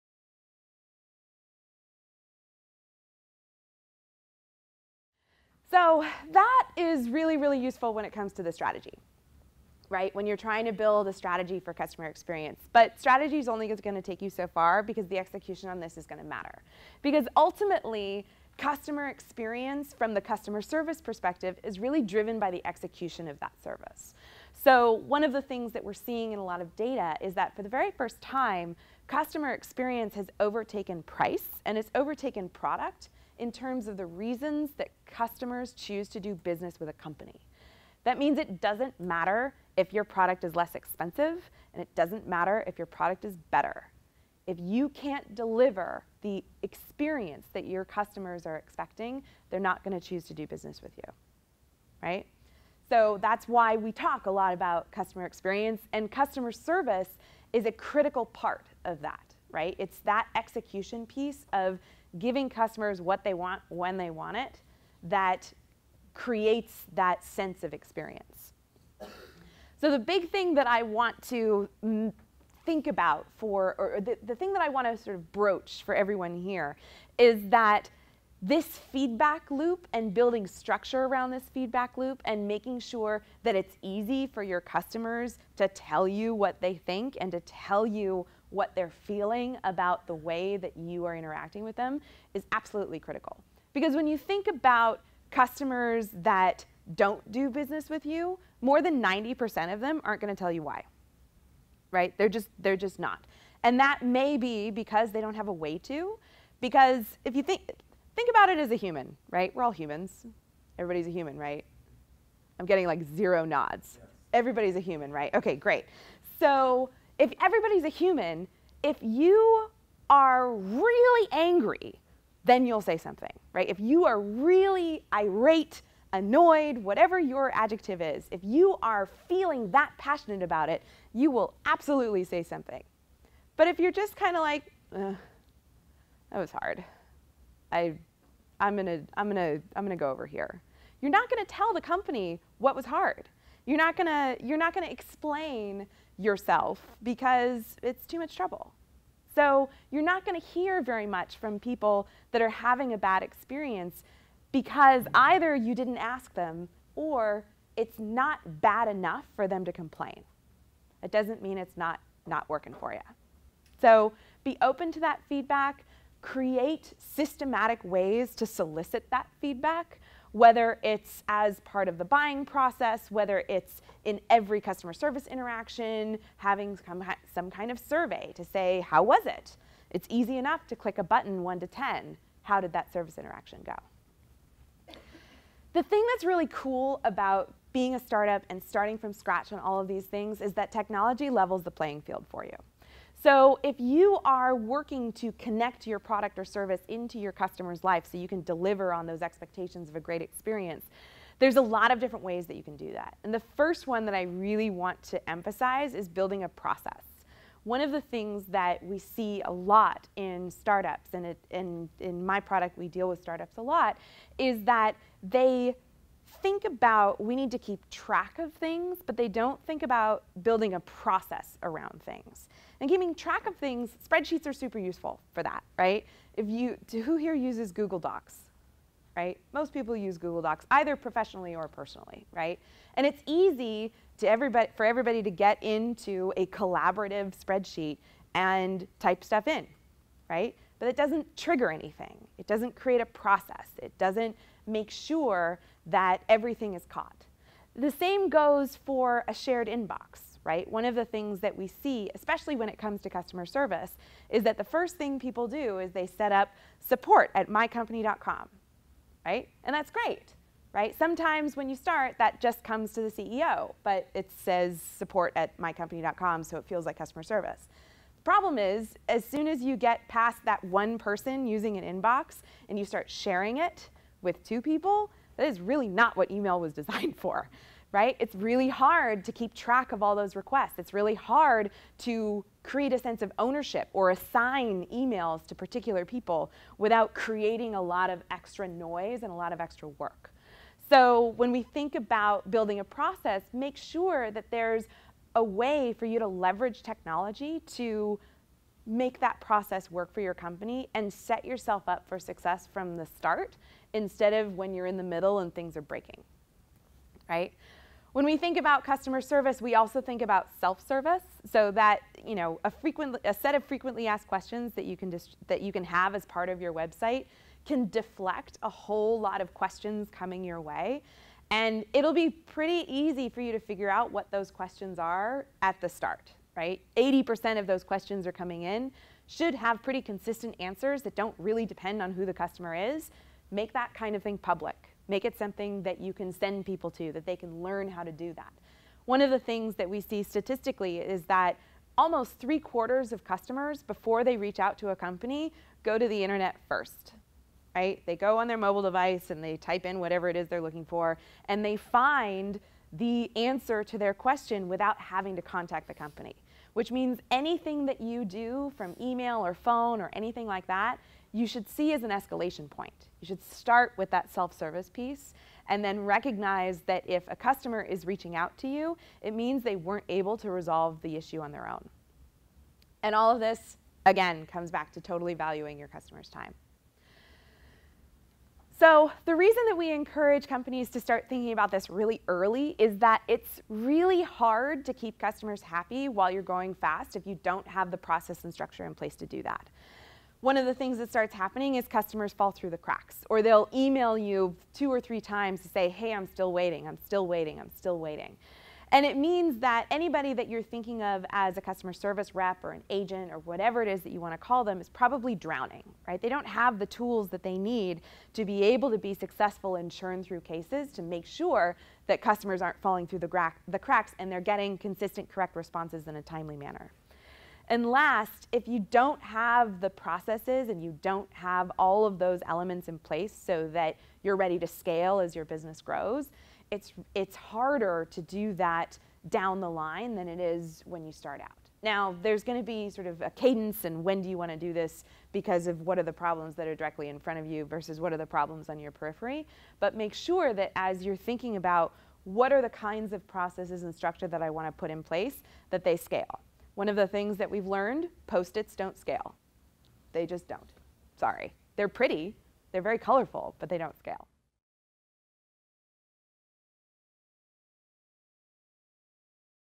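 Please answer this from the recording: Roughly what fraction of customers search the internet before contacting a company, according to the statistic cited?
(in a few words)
Three quarters.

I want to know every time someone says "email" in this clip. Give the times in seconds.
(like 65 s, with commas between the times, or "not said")
276 s, 284 s, 358 s, 393 s.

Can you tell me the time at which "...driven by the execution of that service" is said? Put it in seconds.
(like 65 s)
22 s.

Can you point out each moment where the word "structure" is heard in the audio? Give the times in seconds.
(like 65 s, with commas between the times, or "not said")
80 s, 388 s, 443 s.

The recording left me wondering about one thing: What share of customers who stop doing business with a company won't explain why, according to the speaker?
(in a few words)
More than 90%.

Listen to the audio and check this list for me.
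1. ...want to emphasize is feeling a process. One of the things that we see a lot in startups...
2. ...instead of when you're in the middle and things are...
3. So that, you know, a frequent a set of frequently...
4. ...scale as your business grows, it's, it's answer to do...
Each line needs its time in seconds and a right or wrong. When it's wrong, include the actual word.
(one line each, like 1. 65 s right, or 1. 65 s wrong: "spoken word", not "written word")
1. 204 s wrong: "building", not "feeling"
2. 303 s right
3. 311 s right
4. 424 s wrong: "harder", not "answer".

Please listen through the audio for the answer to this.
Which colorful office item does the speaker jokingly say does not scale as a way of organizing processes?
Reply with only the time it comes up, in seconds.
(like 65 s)
448 s.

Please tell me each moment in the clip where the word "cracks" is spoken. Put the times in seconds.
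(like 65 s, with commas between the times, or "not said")
392 s, 413 s.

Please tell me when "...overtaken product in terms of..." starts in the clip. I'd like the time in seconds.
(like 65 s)
31 s.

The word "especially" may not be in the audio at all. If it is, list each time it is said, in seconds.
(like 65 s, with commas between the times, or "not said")
252 s.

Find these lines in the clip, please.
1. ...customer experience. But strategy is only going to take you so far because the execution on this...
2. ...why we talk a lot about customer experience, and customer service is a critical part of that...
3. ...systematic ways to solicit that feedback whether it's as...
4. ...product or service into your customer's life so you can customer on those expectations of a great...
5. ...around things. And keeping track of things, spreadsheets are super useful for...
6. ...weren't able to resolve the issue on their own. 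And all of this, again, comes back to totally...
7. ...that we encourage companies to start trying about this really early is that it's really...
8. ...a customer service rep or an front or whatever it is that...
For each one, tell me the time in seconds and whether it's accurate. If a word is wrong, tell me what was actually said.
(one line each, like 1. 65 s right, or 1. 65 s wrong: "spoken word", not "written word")
1. 11 s right
2. 53 s right
3. 166 s right
4. 195 s wrong: "deliver", not "customer"
5. 221 s right
6. 369 s right
7. 379 s wrong: "thinking", not "trying"
8. 401 s wrong: "agent", not "front".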